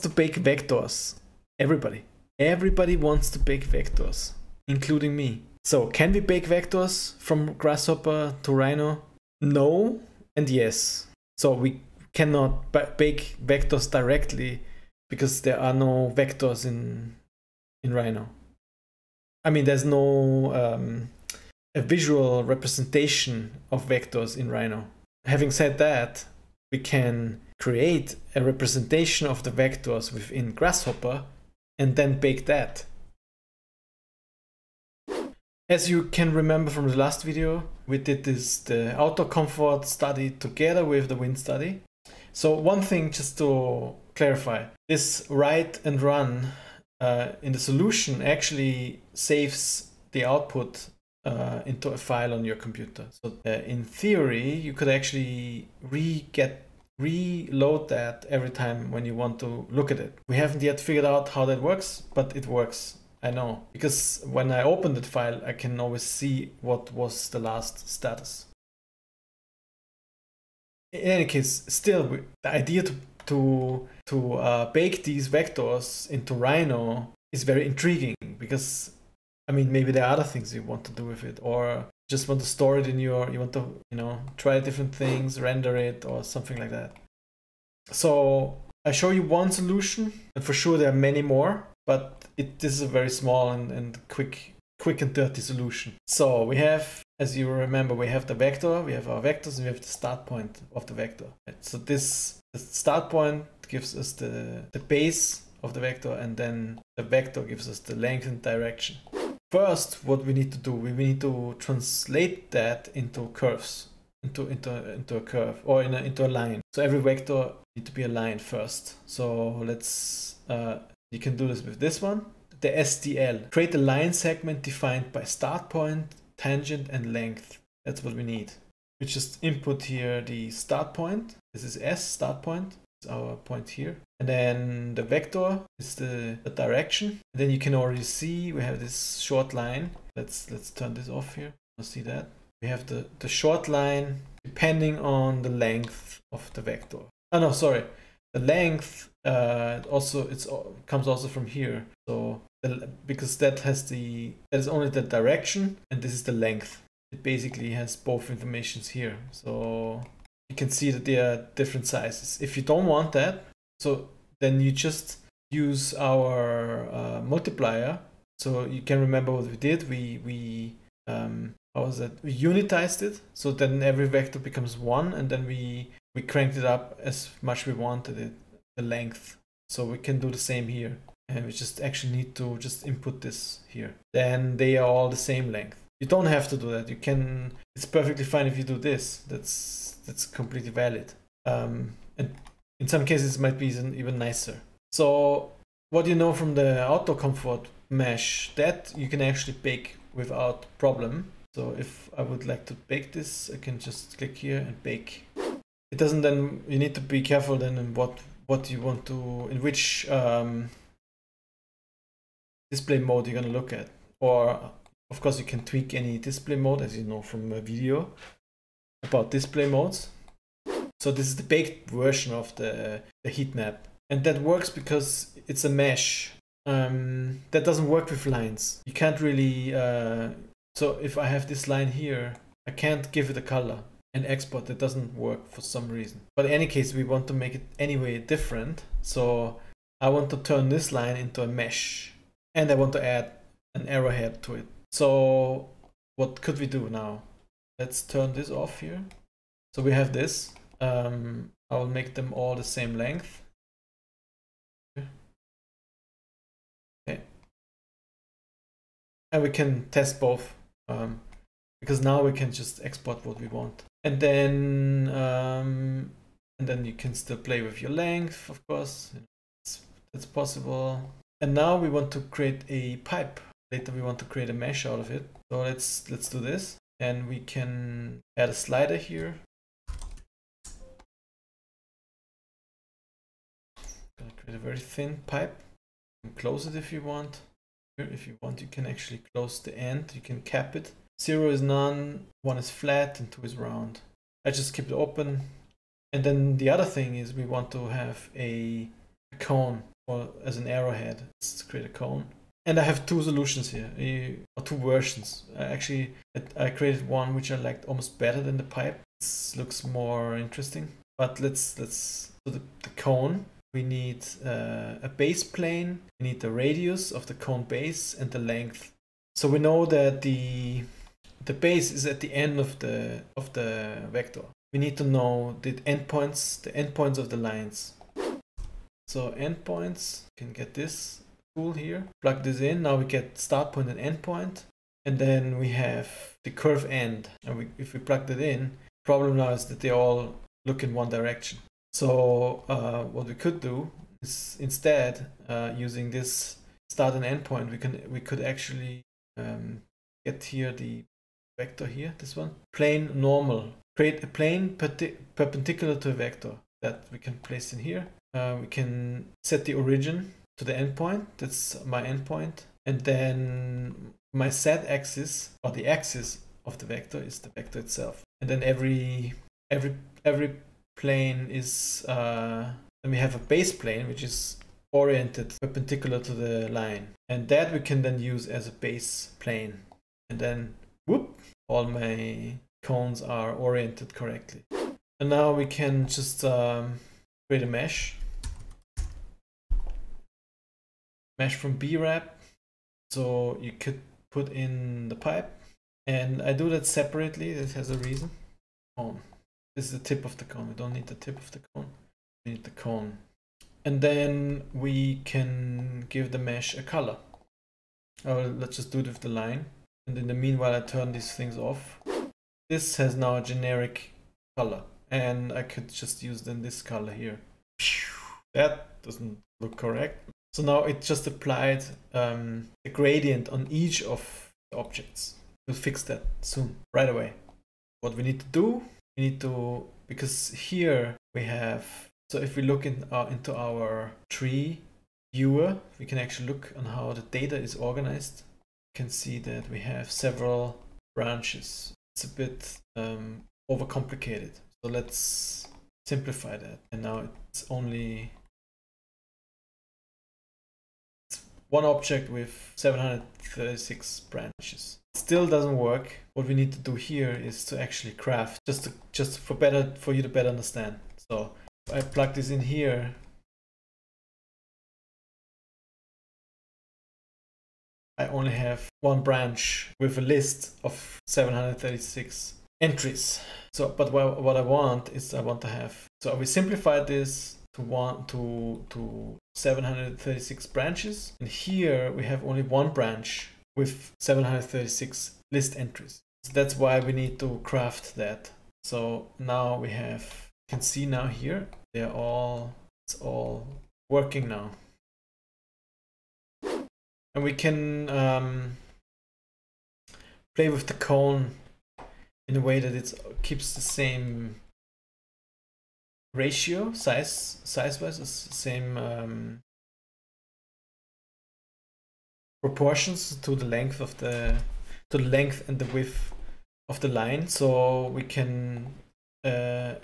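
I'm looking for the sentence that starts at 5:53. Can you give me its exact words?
Create a plane perpendicular to a vector that we can place in here.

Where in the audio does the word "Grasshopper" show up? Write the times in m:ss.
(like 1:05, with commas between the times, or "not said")
0:07, 0:30.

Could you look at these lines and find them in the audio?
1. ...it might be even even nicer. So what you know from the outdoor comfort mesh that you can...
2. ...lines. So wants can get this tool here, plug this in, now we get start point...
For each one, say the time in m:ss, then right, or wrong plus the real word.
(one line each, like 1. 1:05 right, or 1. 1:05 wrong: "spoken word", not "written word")
1. 3:13 right
2. 5:27 wrong: "endpoints", not "wants".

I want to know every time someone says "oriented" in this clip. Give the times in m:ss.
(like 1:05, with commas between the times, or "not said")
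6:14, 6:23.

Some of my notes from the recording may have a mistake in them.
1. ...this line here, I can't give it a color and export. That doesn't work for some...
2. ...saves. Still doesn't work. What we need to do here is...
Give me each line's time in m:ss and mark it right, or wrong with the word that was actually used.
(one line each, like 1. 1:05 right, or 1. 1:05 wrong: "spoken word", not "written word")
1. 3:51 right
2. 7:34 wrong: "branches", not "saves".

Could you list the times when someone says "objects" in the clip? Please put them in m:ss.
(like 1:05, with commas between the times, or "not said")
7:04, 7:31.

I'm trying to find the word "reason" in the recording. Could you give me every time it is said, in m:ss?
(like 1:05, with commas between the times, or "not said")
3:55, 6:37.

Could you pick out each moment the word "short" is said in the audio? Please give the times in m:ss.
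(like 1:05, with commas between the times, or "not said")
2:19, 2:23.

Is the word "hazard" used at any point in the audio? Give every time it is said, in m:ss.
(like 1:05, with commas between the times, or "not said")
not said.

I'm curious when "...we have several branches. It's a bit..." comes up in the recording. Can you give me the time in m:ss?
7:19.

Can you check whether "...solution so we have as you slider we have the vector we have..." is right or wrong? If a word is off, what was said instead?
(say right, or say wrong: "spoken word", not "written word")
wrong: "remember", not "slider".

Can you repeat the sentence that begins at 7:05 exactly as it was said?
We'll fix that soon, right away.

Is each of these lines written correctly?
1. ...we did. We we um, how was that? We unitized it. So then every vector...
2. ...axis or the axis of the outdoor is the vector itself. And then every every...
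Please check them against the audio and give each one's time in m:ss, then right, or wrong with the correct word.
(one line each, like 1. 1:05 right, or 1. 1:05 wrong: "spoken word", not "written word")
1. 2:49 right
2. 6:04 wrong: "vector", not "outdoor".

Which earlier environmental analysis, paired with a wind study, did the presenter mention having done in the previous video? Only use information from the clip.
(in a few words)
Outdoor comfort study.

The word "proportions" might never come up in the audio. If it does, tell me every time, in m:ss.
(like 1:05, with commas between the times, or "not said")
8:32.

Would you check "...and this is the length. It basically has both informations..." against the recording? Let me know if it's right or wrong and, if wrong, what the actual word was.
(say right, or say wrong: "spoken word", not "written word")
right.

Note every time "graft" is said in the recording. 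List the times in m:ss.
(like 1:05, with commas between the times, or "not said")
7:38, 8:07.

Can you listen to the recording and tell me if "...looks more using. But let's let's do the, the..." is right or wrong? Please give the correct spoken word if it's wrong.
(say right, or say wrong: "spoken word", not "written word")
wrong: "interesting", not "using".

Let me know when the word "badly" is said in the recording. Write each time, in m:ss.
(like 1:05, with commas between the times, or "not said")
not said.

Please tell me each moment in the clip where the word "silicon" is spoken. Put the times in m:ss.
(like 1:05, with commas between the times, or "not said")
not said.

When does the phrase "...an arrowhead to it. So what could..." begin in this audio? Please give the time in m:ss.
4:03.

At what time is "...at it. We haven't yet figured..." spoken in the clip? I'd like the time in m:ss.
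0:59.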